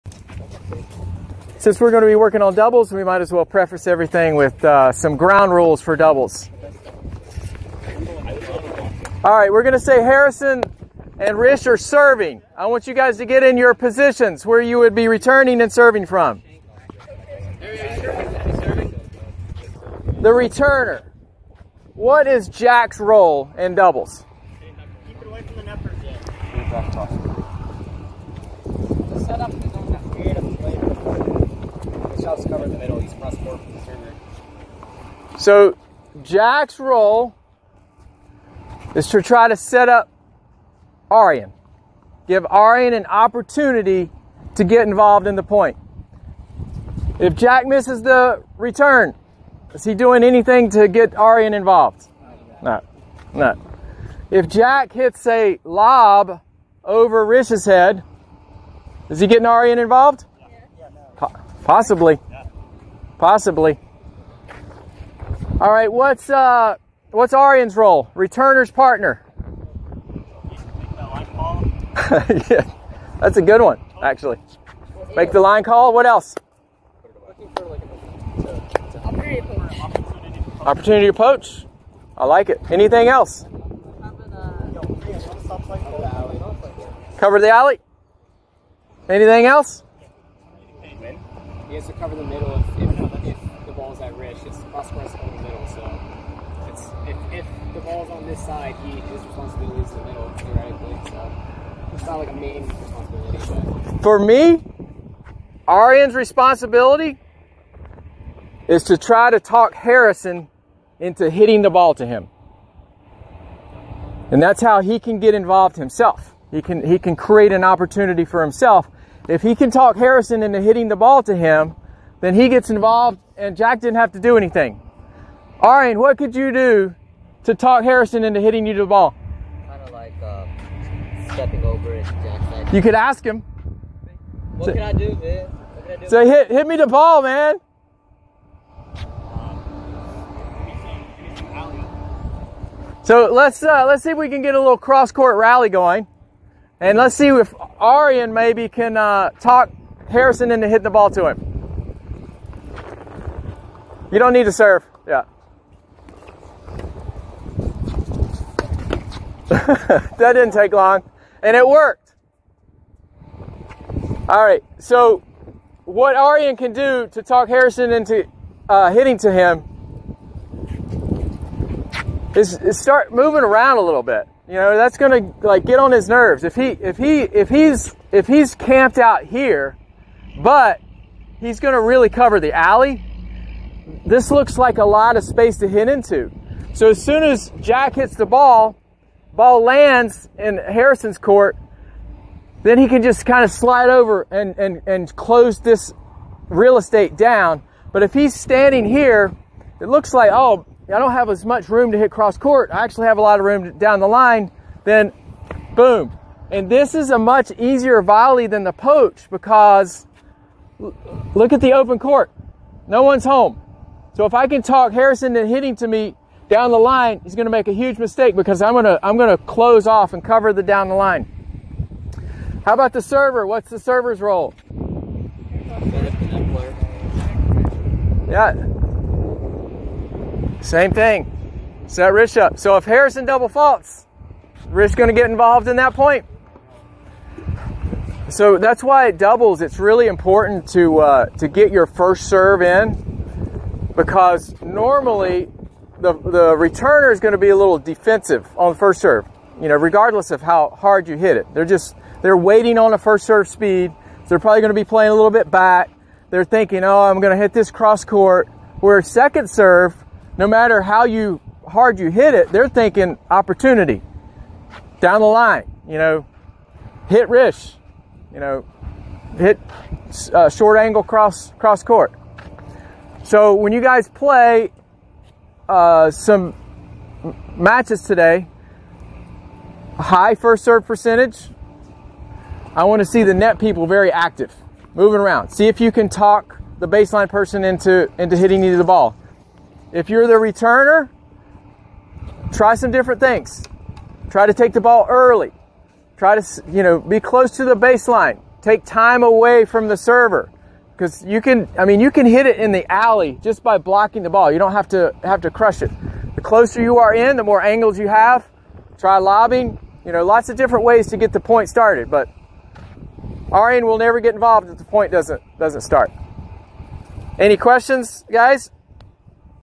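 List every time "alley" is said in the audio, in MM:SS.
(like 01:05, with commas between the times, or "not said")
01:27, 03:02, 05:02.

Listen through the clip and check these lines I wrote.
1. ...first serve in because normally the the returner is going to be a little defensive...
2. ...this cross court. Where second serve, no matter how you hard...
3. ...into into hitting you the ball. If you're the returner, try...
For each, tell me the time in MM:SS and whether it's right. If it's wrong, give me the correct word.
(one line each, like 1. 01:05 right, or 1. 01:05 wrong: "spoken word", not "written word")
1. 04:01 right
2. 04:17 right
3. 04:47 right.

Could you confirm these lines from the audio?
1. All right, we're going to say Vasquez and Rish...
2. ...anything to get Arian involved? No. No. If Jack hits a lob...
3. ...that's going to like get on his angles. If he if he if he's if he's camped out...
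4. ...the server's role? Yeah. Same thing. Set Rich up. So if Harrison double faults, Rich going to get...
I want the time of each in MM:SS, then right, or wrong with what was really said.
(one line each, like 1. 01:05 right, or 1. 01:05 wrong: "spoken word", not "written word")
1. 00:09 wrong: "Harrison", not "Vasquez"
2. 00:50 right
3. 02:54 wrong: "nerves", not "angles"
4. 03:43 right.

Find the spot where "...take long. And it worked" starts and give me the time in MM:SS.
02:40.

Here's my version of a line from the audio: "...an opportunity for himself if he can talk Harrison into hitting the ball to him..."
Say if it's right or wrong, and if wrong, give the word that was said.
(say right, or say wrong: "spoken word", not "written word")
right.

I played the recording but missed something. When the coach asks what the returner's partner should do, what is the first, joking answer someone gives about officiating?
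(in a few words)
Make the line call.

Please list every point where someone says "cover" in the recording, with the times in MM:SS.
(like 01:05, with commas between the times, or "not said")
00:32, 01:27, 01:31, 03:02, 03:40.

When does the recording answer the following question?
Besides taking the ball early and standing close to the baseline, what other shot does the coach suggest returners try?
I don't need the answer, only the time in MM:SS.
05:09.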